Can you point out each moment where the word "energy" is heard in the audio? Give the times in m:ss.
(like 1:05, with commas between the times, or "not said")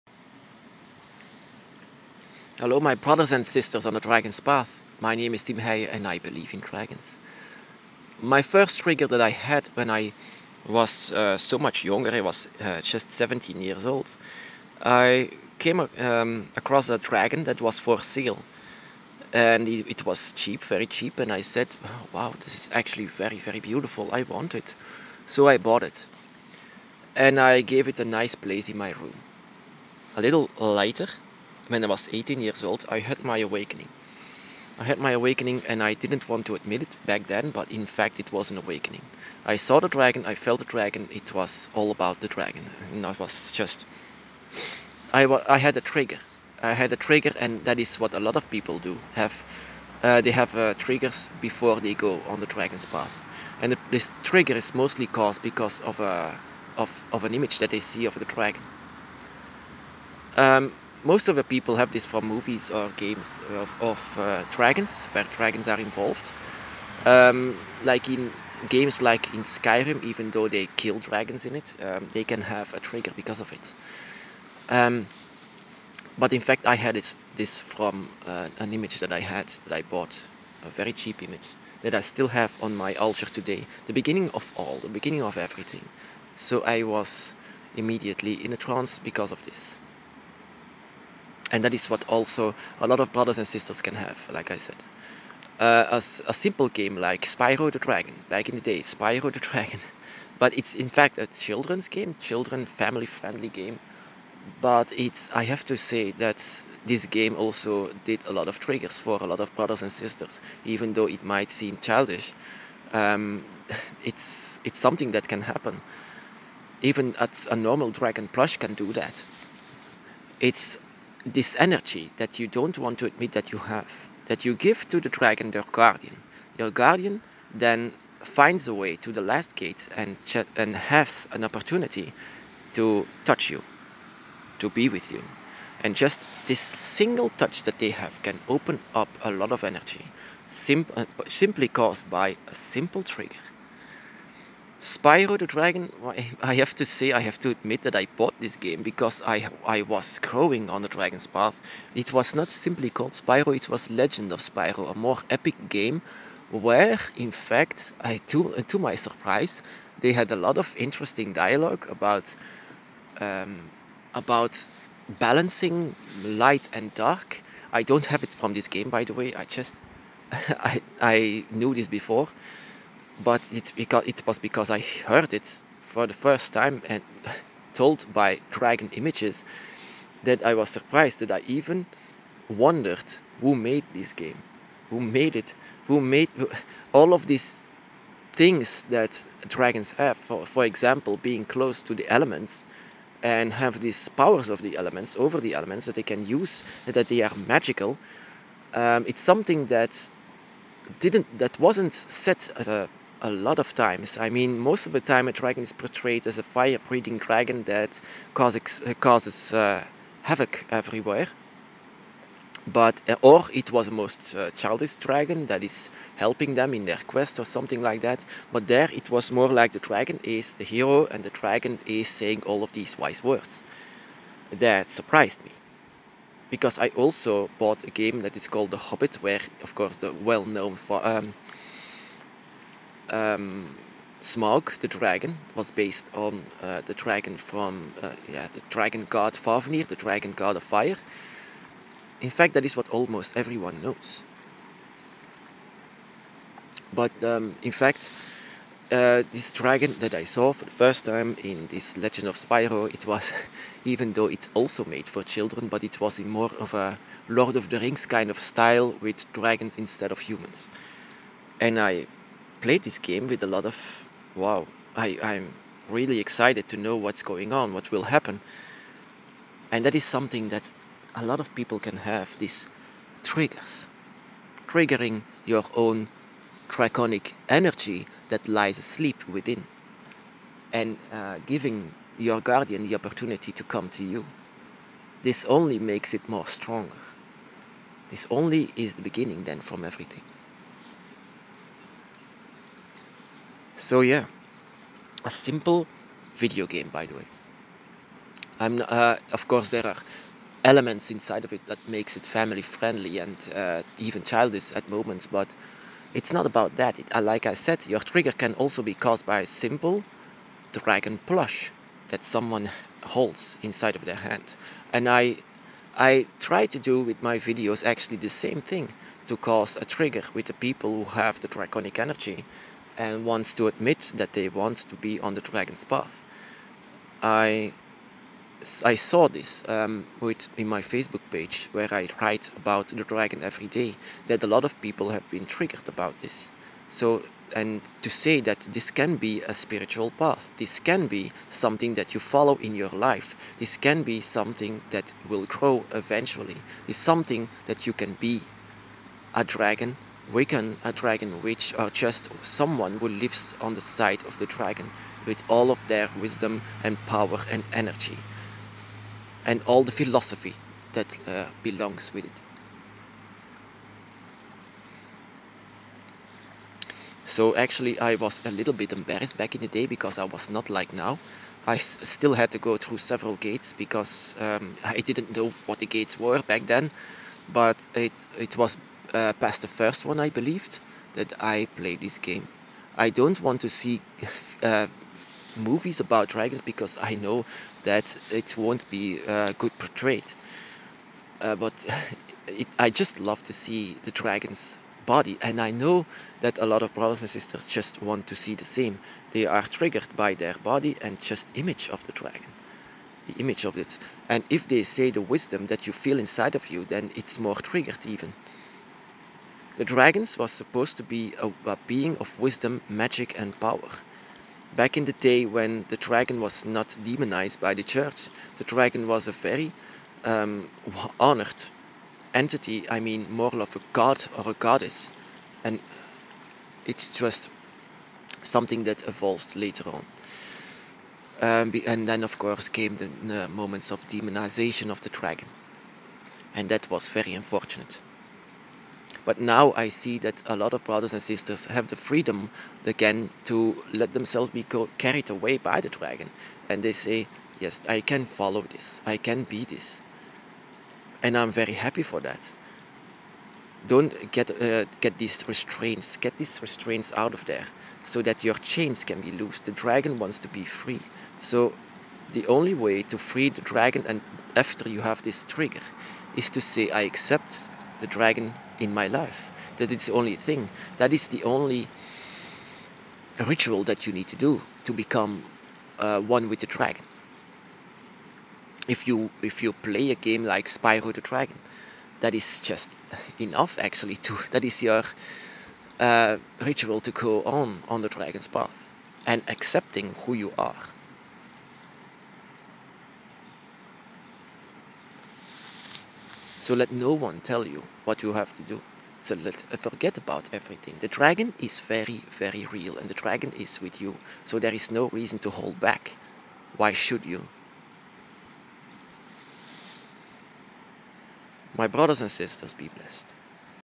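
2:01, 2:19, 4:37, 5:21, 5:57.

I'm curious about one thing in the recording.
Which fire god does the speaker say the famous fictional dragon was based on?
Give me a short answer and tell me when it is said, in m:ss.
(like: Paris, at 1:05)
Fafnir, at 3:59.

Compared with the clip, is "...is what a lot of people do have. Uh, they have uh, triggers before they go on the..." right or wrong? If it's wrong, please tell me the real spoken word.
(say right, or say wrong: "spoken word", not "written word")
right.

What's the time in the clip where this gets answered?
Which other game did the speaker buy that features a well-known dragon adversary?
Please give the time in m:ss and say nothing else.
3:48.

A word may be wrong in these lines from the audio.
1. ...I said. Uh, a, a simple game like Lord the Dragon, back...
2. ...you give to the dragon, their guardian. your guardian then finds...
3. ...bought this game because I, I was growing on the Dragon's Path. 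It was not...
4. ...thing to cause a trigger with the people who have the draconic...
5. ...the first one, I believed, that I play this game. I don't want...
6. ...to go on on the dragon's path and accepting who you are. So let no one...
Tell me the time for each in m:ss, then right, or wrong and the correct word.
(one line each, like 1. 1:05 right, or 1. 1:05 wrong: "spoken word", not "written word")
1. 1:34 wrong: "Spyro", not "Lord"
2. 2:04 right
3. 2:28 right
4. 5:18 right
5. 6:19 right
6. 8:07 right.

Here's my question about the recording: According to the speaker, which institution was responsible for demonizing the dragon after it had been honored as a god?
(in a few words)
the church.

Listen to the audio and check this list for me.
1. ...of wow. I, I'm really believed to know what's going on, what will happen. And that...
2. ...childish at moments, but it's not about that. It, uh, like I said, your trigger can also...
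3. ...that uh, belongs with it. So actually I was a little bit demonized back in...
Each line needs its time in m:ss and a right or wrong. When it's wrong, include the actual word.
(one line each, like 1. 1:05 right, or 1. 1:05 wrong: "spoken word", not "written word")
1. 4:23 wrong: "excited", not "believed"
2. 5:04 right
3. 6:00 wrong: "embarrassed", not "demonized".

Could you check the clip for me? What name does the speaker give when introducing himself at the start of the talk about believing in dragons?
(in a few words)
Tim Heye.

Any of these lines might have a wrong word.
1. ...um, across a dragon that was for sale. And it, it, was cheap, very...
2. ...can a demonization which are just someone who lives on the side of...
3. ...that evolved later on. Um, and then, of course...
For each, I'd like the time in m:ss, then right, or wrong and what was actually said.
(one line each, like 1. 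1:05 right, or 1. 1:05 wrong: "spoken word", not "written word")
1. 0:15 right
2. 5:50 wrong: "dragon", not "demonization"
3. 7:08 right.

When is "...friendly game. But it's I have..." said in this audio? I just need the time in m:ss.
1:43.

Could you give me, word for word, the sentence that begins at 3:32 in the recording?
But uh, or it was a most uh, childish dragon that is helping them in their quest or something like that.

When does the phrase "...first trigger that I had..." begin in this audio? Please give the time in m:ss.
0:08.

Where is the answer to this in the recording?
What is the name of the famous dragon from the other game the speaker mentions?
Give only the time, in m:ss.
3:54.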